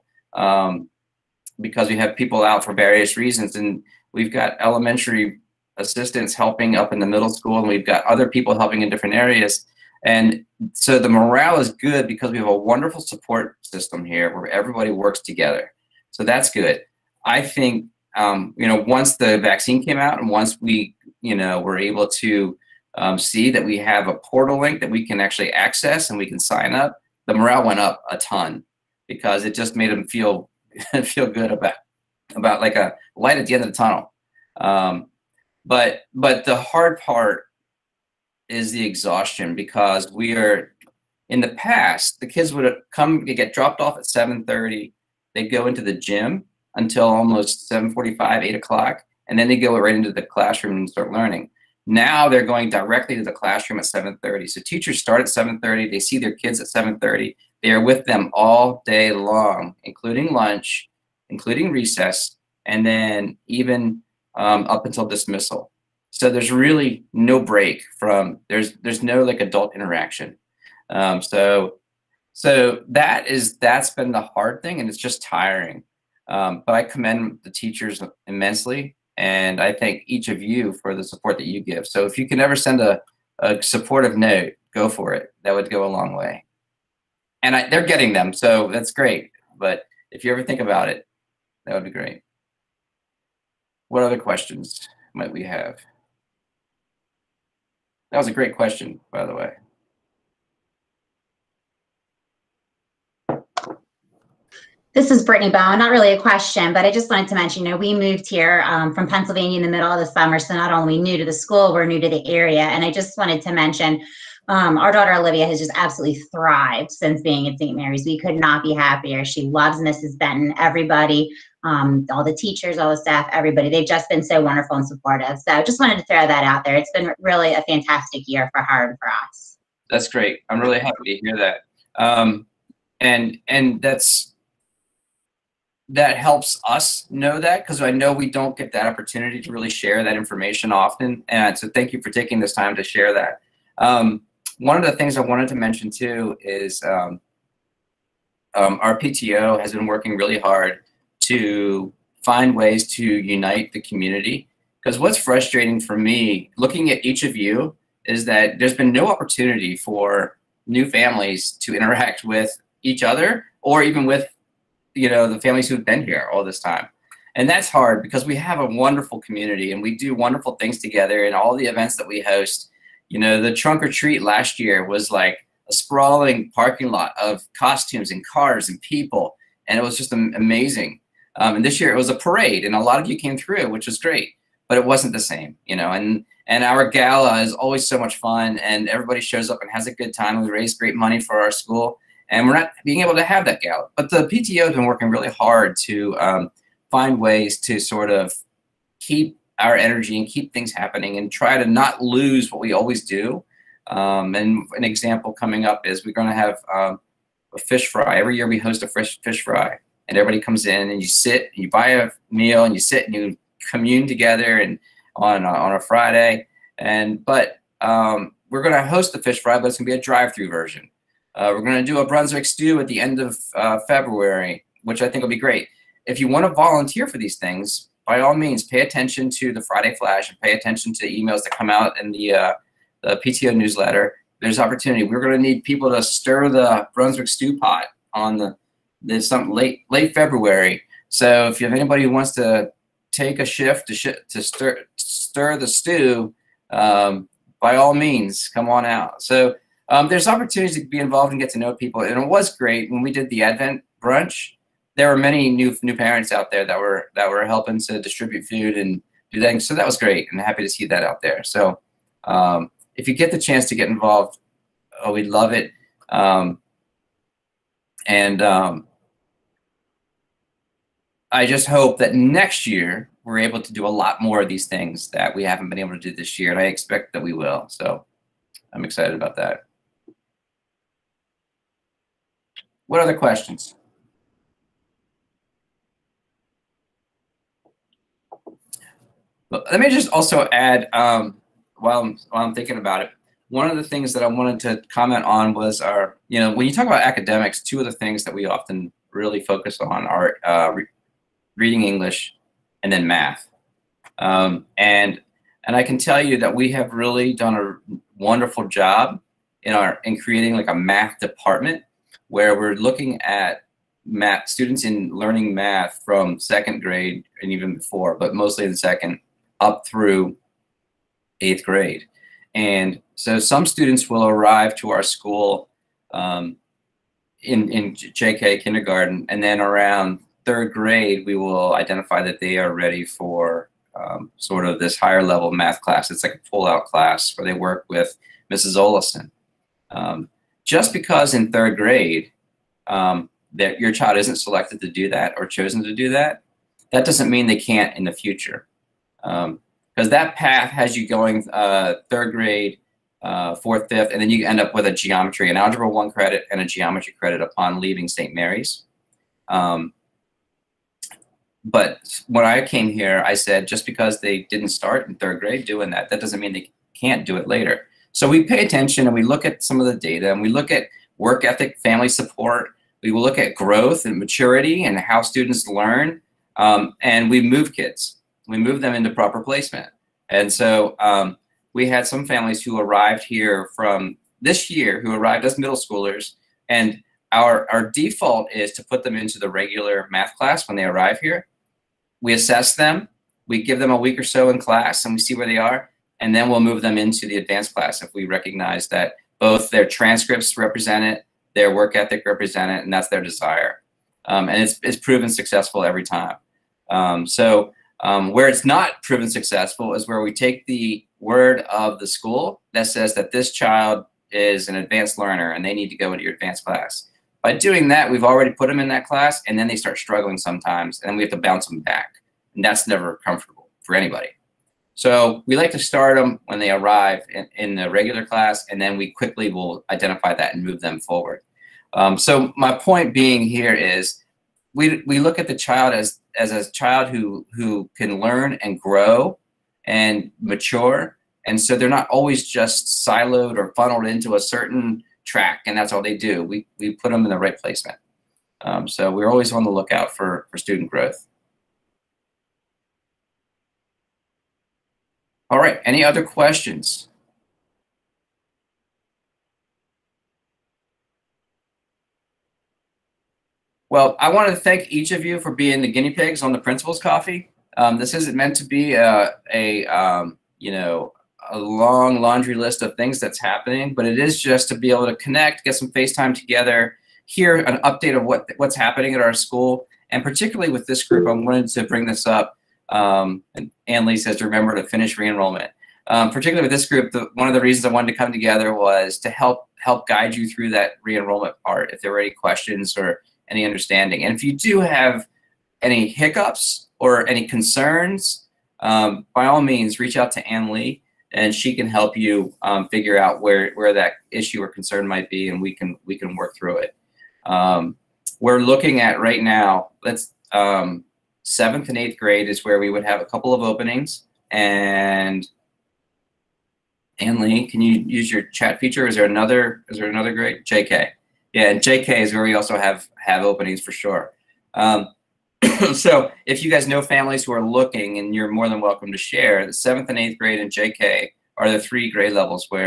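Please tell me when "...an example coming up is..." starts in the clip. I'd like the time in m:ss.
3:24.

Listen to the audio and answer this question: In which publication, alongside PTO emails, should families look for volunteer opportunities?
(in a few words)
Friday Flash.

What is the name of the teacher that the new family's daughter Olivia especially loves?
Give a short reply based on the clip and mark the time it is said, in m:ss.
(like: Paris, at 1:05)
Mrs. Benton, at 1:59.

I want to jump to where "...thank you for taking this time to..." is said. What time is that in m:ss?
2:21.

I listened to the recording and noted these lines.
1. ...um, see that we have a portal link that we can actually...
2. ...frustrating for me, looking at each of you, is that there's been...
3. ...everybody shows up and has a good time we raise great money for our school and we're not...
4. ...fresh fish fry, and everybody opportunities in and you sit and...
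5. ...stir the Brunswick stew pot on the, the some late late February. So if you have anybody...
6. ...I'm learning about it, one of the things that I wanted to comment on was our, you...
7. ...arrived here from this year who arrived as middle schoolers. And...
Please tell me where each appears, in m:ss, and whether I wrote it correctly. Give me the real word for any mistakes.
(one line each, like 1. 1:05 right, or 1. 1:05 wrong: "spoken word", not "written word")
1. 0:22 right
2. 2:35 right
3. 3:08 right
4. 3:28 wrong: "comes", not "opportunities"
5. 3:56 right
6. 4:52 wrong: "thinking", not "learning"
7. 6:22 right.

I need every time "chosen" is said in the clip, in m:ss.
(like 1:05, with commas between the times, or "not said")
5:45.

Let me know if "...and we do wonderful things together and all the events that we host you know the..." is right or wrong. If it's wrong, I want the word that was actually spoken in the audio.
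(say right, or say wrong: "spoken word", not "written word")
right.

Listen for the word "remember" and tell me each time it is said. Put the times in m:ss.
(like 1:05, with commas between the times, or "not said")
8:04.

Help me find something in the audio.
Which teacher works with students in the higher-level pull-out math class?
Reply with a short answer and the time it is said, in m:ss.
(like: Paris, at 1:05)
Mrs. Olison, at 5:38.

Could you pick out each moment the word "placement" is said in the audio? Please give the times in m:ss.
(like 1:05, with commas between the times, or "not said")
6:19, 7:27.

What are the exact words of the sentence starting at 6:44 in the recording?
Um, and it's, it's proven successful every time.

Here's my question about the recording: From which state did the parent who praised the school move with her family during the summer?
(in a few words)
Pennsylvania.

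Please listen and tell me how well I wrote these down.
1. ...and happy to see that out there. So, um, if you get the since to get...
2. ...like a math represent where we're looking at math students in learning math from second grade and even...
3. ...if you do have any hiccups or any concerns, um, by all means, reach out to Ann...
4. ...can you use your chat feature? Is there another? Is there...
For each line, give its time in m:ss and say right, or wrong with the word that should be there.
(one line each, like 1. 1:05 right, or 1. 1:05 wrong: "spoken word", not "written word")
1. 4:20 wrong: "chance", not "since"
2. 5:10 wrong: "department", not "represent"
3. 8:14 right
4. 8:37 right.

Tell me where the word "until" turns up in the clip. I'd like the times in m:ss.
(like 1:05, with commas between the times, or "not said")
0:46, 1:04.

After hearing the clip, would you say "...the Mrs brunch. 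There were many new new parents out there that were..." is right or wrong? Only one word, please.
wrong.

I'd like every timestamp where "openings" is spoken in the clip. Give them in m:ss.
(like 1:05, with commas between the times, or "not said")
8:33, 8:43.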